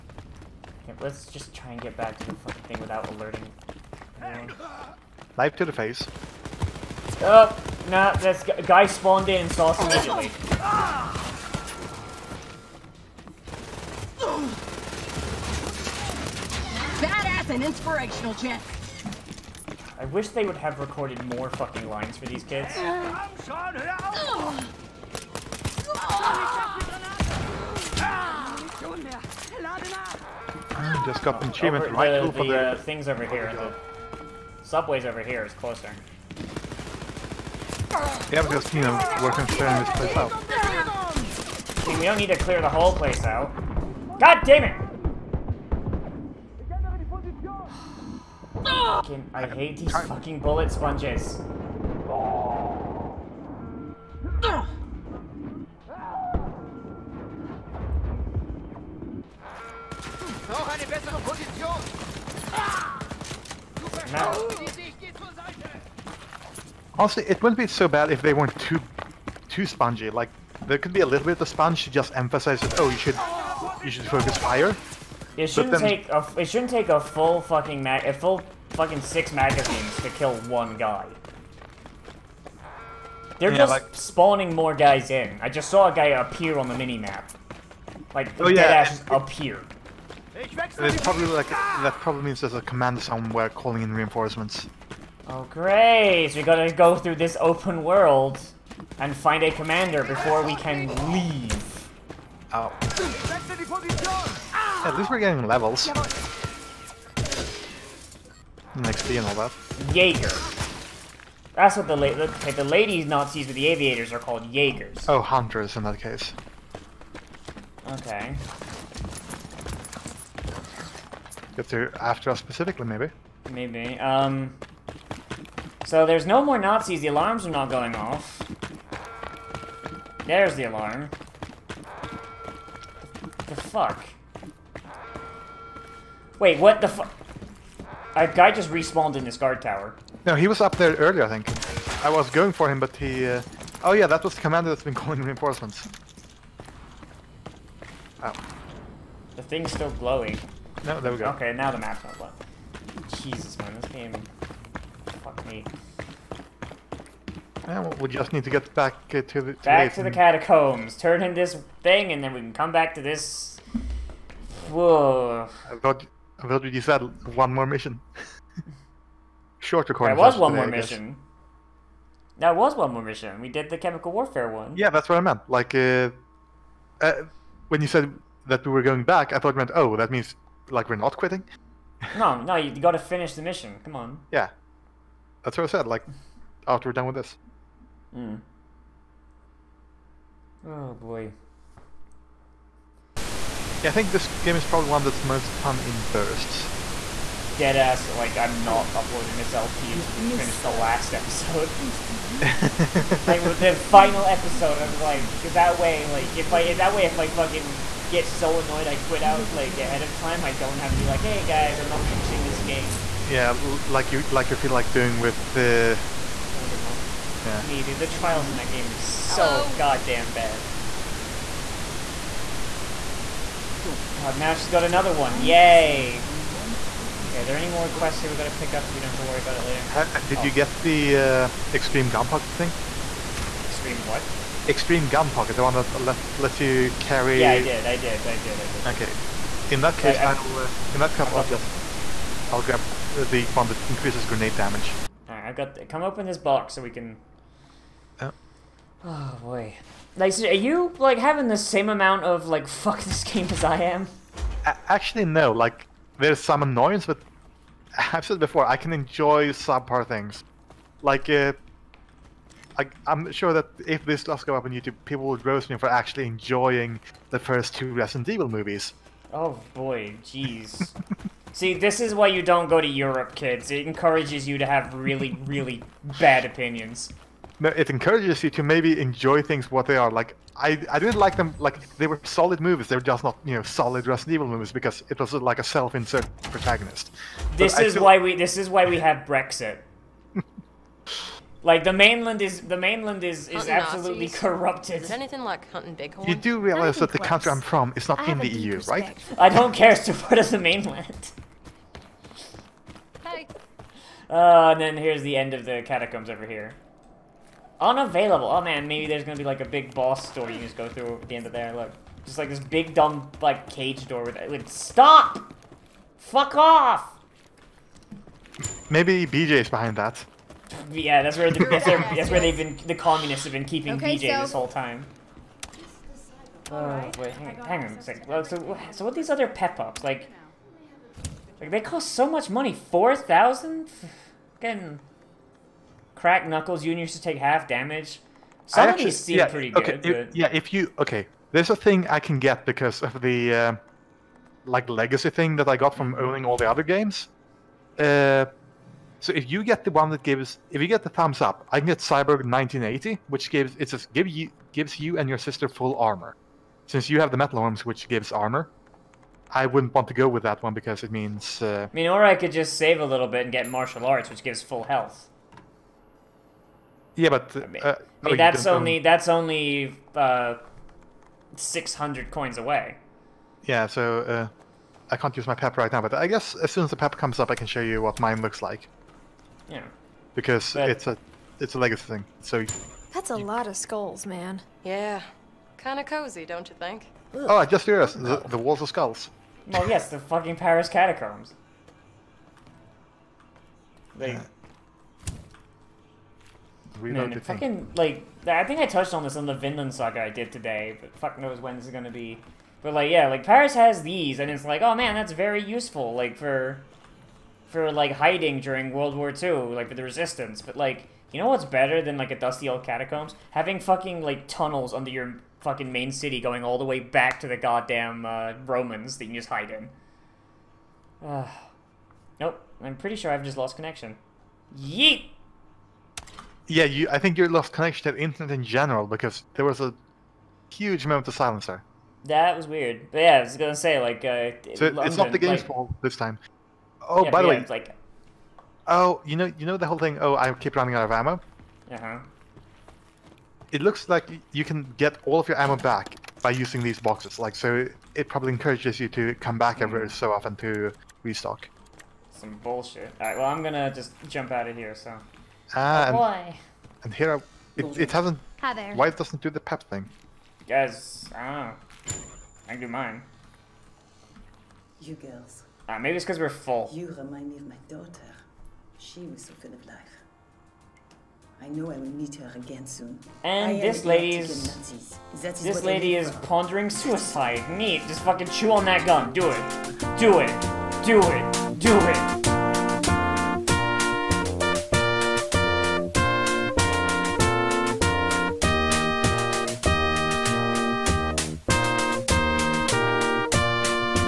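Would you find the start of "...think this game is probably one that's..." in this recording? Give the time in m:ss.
3:13.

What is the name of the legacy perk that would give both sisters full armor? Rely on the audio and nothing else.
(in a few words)
Cyborg 1980.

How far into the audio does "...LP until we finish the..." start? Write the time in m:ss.
3:19.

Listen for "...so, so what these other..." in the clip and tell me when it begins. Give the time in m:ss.
5:28.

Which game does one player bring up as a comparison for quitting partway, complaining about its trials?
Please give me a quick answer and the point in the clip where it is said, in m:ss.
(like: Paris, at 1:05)
Danganronpa, at 3:36.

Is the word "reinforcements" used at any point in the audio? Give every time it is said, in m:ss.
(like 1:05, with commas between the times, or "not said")
1:33, 2:25.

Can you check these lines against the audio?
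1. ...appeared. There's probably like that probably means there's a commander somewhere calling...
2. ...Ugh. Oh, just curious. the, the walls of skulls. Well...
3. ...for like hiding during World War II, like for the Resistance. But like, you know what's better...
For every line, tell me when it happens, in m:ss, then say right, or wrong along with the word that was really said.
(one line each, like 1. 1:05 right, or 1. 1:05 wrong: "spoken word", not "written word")
1. 1:29 right
2. 6:27 right
3. 6:47 right.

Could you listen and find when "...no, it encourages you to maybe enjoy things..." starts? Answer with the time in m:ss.
4:37.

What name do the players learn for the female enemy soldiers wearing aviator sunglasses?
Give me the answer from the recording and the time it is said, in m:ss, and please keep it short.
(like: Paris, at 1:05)
Jaegers, at 1:54.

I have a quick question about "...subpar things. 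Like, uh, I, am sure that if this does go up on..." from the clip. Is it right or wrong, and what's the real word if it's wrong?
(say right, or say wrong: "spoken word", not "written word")
right.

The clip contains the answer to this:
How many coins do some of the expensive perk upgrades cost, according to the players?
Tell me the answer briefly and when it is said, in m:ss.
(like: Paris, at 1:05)
4000, at 5:32.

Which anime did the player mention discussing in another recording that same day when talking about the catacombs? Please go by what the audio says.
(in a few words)
Vinland Saga.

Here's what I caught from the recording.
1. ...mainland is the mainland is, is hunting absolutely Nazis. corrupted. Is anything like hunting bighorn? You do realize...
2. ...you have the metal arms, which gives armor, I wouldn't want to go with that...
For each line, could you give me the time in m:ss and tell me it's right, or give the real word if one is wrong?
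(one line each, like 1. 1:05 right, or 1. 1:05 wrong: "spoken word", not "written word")
1. 4:51 right
2. 5:57 right.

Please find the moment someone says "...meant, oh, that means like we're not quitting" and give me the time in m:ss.
2:59.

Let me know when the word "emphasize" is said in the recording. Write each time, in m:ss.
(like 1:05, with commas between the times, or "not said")
1:12.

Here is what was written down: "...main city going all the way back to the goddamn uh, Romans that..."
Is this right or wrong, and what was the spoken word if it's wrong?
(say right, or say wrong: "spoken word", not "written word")
right.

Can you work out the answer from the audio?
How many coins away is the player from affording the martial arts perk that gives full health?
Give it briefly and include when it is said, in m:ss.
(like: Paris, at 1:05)
600, at 6:11.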